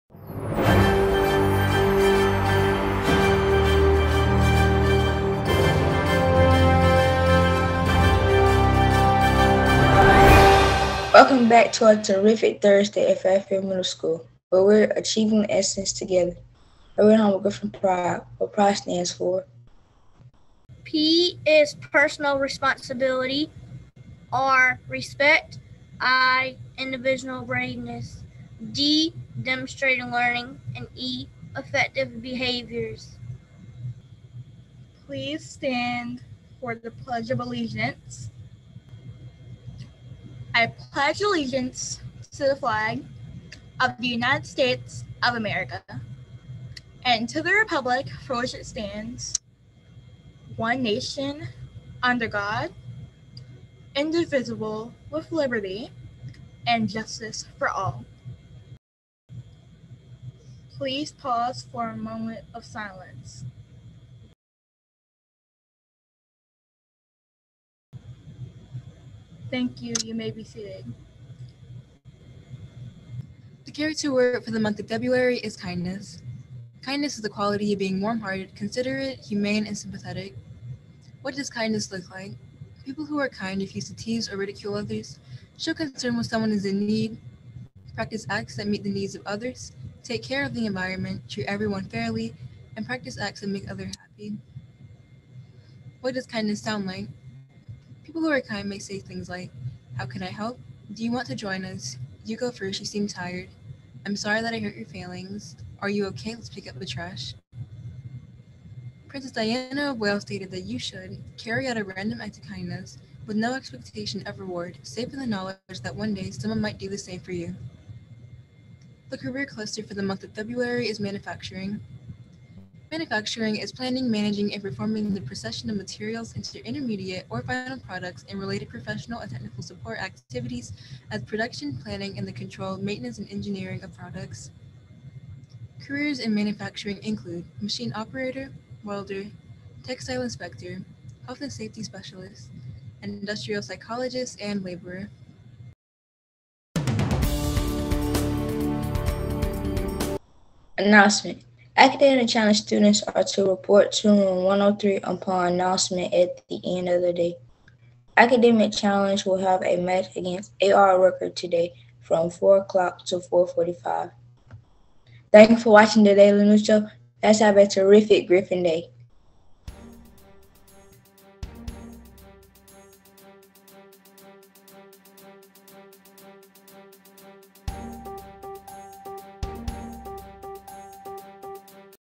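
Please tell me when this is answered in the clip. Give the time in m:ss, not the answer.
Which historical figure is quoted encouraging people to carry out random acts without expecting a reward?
1:49.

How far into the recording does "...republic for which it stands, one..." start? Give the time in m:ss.
0:47.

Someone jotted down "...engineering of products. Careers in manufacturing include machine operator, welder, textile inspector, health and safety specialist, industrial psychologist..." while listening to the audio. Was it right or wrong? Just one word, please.
right.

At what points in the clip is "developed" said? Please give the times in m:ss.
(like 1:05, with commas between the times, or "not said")
not said.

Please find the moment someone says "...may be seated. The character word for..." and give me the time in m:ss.
1:10.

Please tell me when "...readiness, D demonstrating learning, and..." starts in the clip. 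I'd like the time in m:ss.
0:27.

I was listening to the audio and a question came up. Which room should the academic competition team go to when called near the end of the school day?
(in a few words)
Room 103.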